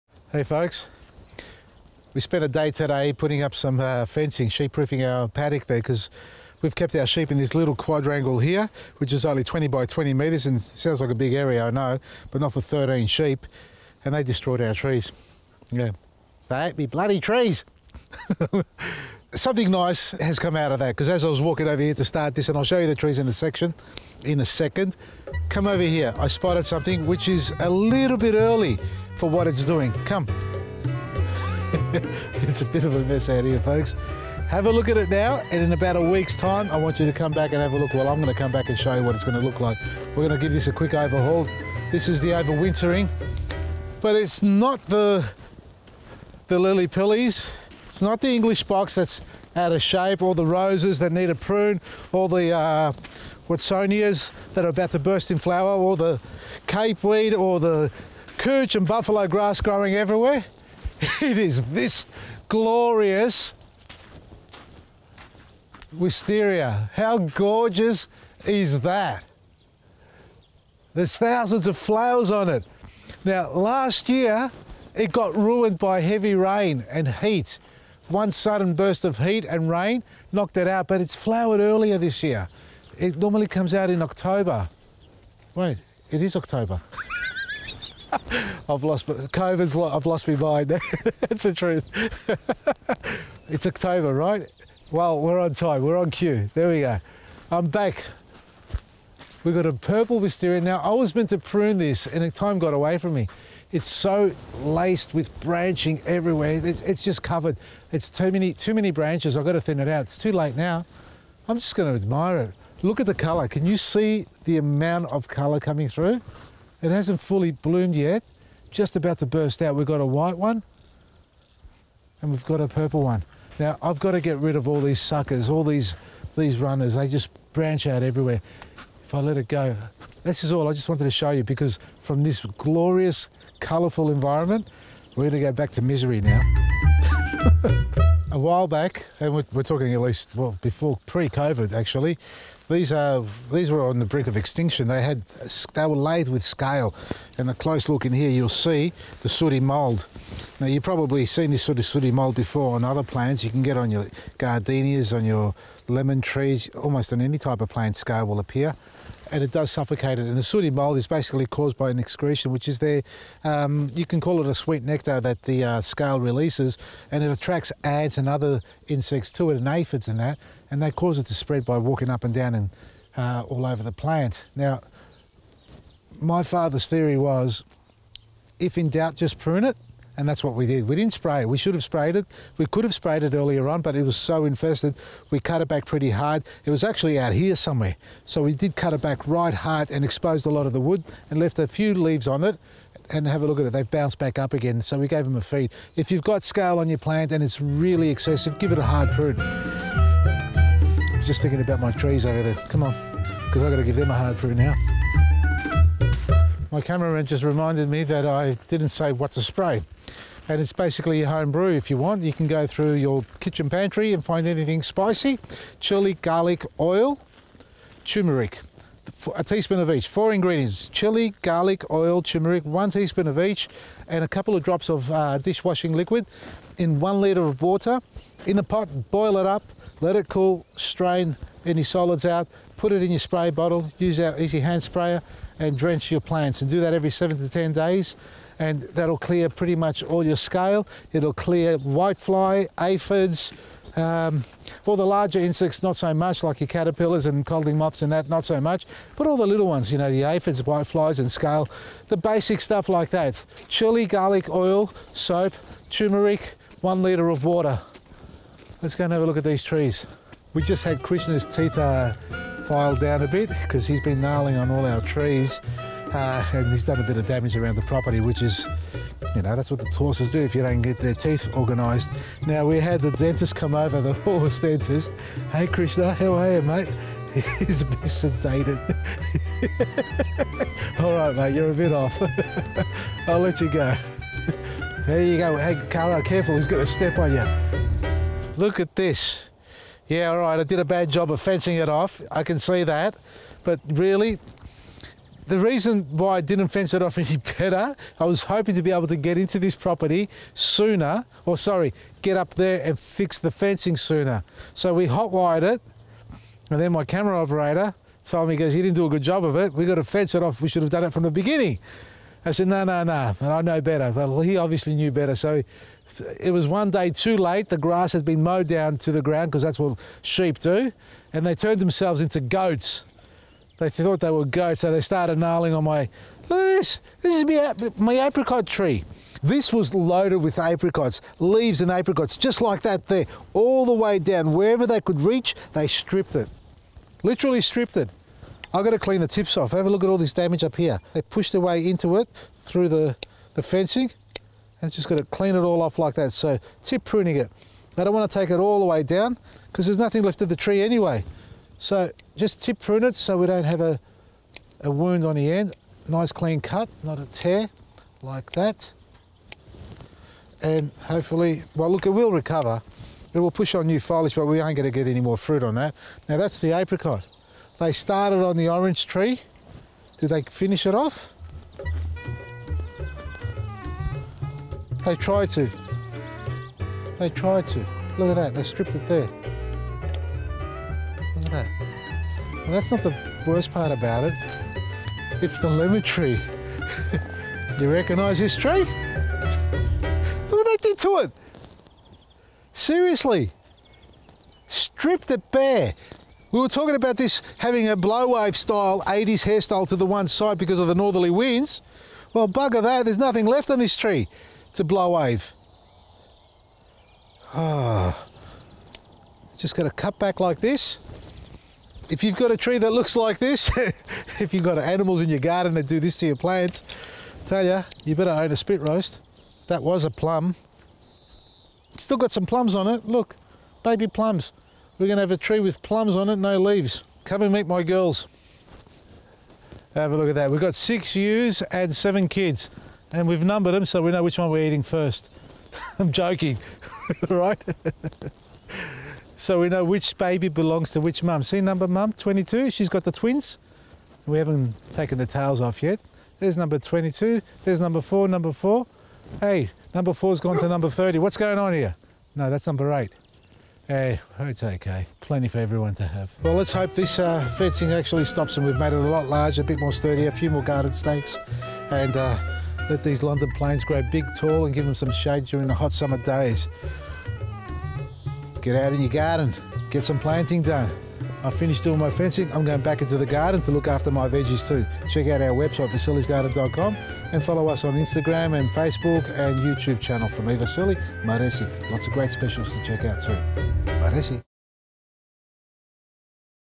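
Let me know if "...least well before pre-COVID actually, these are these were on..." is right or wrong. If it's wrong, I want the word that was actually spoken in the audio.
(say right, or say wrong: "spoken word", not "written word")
right.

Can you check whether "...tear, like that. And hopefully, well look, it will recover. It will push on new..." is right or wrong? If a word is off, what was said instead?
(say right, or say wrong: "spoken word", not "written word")
right.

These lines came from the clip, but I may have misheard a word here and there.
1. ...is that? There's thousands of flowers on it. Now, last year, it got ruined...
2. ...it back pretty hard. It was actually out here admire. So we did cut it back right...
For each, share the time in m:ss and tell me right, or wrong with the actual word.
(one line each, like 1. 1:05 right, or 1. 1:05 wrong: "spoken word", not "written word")
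1. 1:08 right
2. 3:05 wrong: "somewhere", not "admire".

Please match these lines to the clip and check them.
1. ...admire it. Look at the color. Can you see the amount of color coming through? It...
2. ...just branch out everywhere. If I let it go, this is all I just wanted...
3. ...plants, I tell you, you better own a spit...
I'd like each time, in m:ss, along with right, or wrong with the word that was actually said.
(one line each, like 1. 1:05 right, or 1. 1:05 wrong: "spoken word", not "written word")
1. 1:51 right
2. 2:07 right
3. 6:56 right.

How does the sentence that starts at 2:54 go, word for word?
Now, my father's theory was if in doubt, just prune it.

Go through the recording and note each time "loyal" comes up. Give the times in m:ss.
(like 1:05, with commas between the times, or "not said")
not said.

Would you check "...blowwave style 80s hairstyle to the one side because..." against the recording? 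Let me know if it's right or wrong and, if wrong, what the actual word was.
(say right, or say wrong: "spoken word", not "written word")
right.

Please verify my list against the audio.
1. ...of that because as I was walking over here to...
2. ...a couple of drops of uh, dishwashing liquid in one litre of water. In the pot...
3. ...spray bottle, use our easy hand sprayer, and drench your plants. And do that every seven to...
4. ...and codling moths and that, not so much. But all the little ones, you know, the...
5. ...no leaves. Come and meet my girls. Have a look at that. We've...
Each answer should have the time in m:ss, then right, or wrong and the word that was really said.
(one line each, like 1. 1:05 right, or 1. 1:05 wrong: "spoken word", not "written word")
1. 0:20 right
2. 3:44 right
3. 3:53 right
4. 4:07 right
5. 7:06 right.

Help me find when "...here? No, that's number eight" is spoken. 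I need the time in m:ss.
7:31.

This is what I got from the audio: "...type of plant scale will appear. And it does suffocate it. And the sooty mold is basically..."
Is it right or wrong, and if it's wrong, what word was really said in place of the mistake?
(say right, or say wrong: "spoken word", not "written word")
right.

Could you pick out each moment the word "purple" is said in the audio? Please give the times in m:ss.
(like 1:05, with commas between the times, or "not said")
1:39, 2:02.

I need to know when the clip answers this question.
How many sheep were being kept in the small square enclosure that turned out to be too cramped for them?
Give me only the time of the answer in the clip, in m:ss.
0:12.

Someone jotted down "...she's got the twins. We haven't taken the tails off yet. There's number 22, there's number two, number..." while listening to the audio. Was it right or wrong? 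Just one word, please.
wrong.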